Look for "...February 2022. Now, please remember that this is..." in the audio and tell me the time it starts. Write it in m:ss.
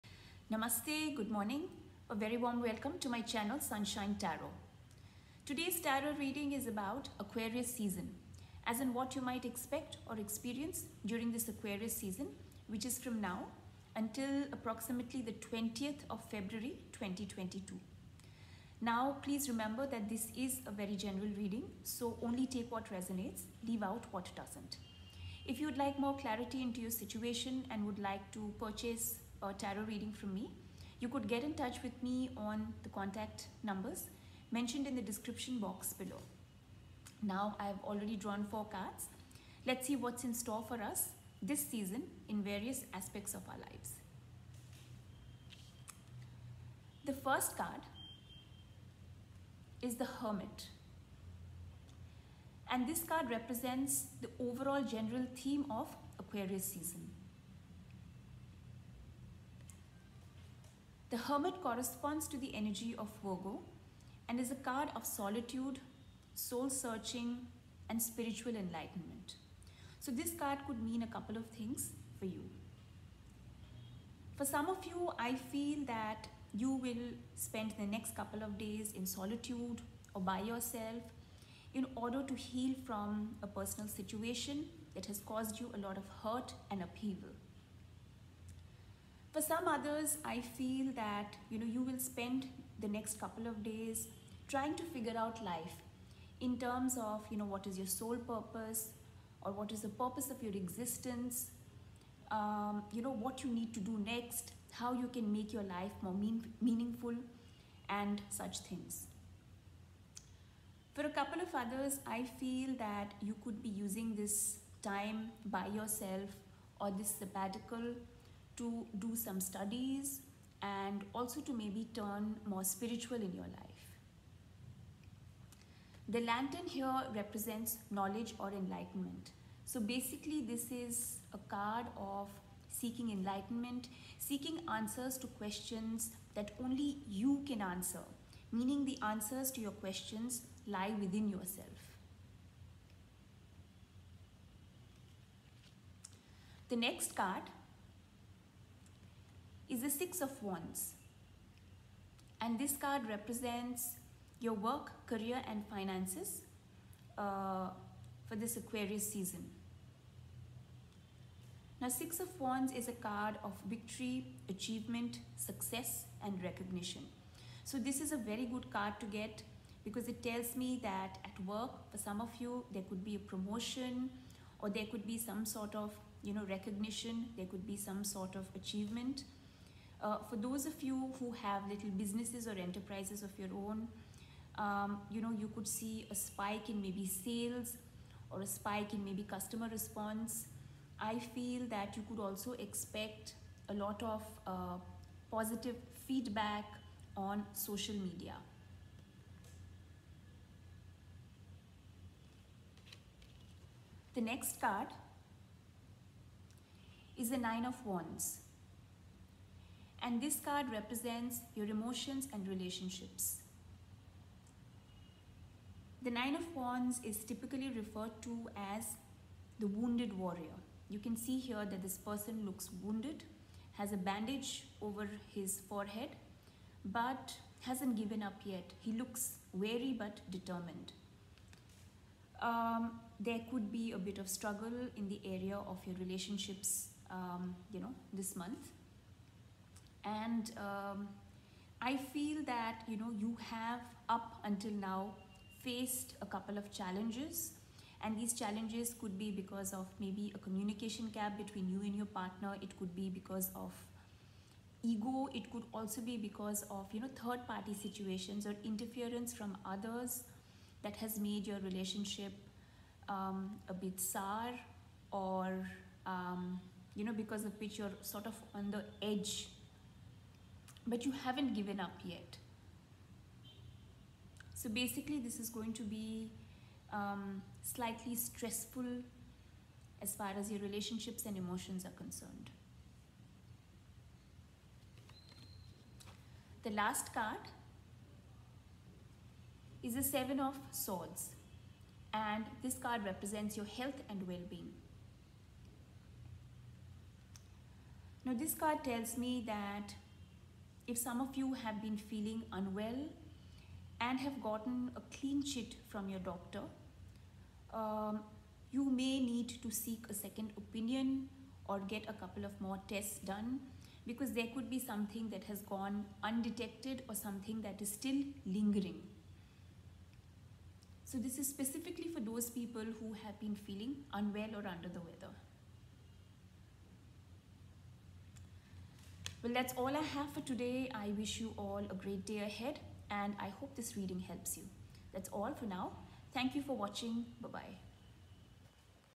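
0:16.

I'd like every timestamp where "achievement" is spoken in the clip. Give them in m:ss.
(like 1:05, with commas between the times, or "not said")
2:44, 2:58.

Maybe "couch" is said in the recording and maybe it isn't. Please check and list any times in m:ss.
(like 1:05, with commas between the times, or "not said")
not said.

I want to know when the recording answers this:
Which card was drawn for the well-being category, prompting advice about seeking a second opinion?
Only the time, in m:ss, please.
4:50.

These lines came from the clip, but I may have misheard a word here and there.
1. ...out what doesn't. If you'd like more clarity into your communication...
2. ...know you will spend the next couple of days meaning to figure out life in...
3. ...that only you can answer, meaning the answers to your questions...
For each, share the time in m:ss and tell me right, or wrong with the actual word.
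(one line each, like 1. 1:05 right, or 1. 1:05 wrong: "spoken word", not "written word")
1. 0:23 wrong: "situation", not "communication"
2. 1:31 wrong: "trying", not "meaning"
3. 2:16 right.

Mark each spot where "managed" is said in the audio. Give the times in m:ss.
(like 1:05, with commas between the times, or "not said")
not said.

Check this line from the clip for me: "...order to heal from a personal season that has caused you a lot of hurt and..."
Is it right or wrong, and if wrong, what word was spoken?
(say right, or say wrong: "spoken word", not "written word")
wrong: "situation", not "season".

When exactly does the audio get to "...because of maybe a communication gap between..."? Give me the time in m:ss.
4:09.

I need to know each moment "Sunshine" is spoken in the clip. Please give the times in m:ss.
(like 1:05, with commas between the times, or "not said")
0:03.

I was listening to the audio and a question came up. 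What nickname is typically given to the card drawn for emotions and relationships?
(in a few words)
The wounded warrior.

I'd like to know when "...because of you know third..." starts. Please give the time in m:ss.
4:16.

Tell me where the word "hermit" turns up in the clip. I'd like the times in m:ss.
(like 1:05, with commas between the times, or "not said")
0:50, 1:01.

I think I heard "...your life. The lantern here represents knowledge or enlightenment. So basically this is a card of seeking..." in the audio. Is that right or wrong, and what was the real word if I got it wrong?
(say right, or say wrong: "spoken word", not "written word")
right.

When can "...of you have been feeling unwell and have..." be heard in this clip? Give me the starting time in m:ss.
5:01.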